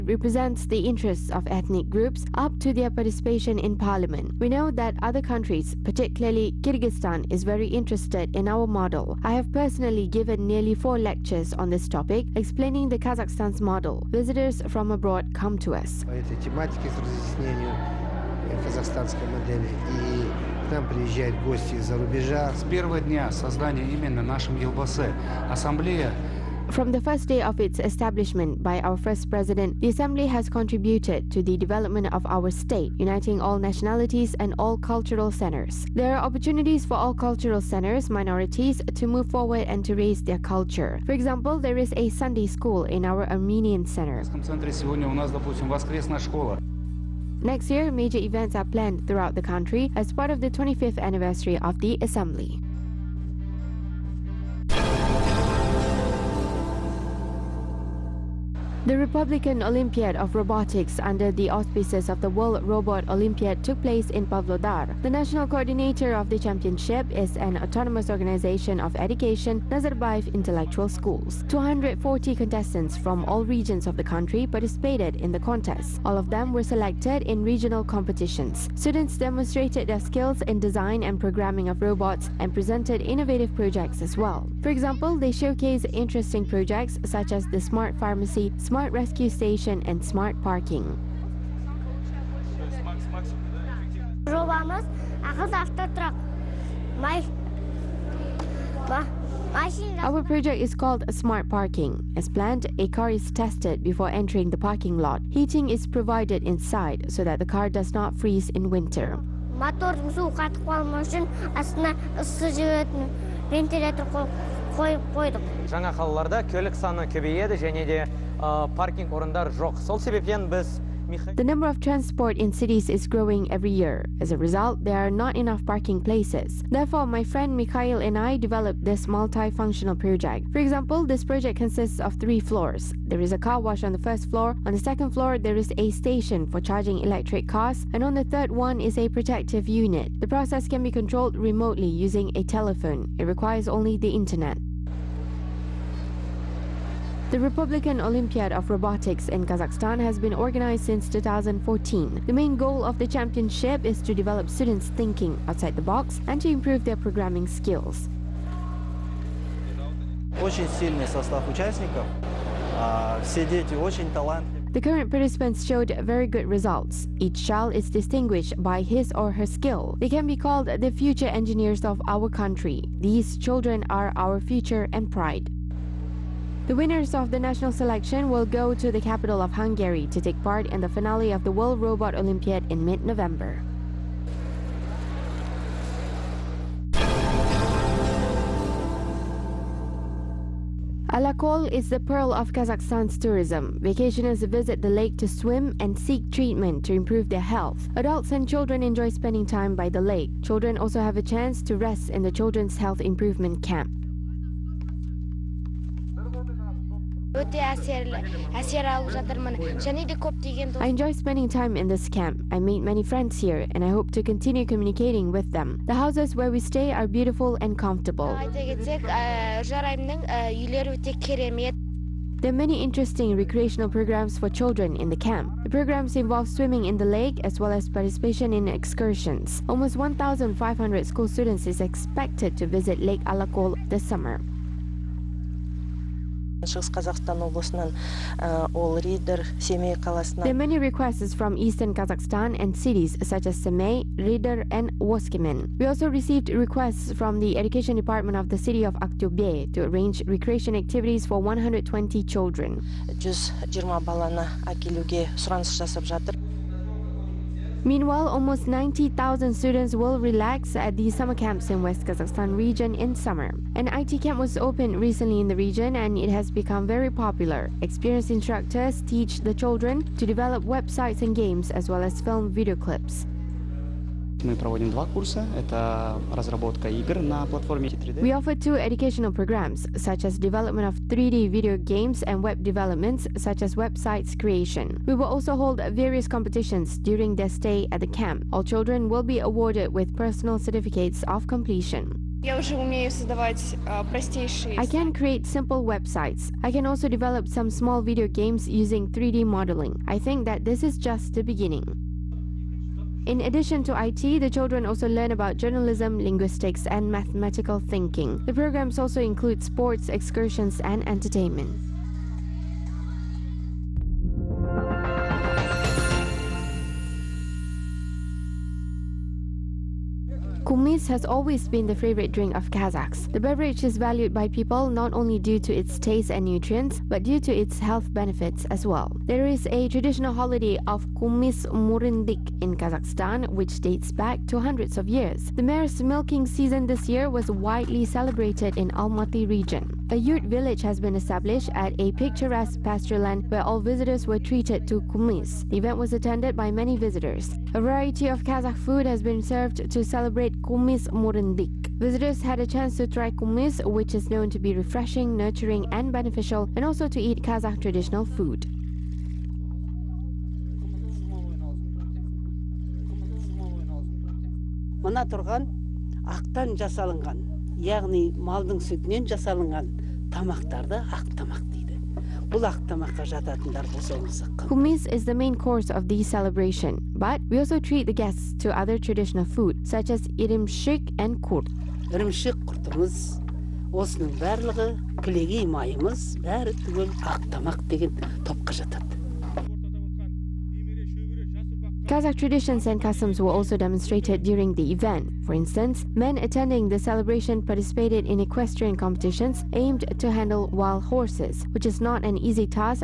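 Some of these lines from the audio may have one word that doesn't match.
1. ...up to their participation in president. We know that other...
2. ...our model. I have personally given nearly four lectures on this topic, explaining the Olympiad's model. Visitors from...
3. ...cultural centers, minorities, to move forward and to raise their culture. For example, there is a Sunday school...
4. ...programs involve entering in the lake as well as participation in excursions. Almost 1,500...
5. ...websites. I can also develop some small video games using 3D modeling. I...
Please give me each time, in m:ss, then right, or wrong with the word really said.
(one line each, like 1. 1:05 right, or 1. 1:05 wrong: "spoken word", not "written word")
1. 0:02 wrong: "parliament", not "president"
2. 0:08 wrong: "Kazakhstan", not "Olympiad"
3. 0:37 right
4. 3:45 wrong: "swimming", not "entering"
5. 4:55 right.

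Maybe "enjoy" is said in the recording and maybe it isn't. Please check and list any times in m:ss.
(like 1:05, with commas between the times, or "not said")
3:18, 3:30.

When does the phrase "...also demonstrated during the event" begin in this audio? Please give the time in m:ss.
6:33.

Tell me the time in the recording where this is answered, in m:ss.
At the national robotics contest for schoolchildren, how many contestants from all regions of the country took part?
1:11.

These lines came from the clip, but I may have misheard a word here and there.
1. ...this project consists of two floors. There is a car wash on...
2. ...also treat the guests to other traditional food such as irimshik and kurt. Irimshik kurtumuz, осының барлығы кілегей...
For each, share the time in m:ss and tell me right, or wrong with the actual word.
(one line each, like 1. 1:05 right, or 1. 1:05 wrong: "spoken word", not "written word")
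1. 2:11 wrong: "three", not "two"
2. 6:17 right.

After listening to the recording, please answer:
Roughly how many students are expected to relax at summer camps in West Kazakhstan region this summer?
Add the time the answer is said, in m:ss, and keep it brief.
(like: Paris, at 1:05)
90,000, at 4:18.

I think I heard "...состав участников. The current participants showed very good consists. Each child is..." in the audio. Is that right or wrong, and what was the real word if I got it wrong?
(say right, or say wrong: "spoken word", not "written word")
wrong: "results", not "consists".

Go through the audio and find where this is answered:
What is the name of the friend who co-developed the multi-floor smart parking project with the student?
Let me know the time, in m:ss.
2:07.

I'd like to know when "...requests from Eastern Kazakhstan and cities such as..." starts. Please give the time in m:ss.
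4:00.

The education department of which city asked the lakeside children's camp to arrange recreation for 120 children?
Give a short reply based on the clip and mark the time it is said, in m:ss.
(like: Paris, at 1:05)
Aktobe, at 4:09.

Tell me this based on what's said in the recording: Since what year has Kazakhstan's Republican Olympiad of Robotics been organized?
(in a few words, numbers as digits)
2014.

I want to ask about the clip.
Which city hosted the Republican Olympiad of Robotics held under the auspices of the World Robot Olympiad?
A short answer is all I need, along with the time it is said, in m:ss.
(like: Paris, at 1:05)
Pavlodar, at 1:04.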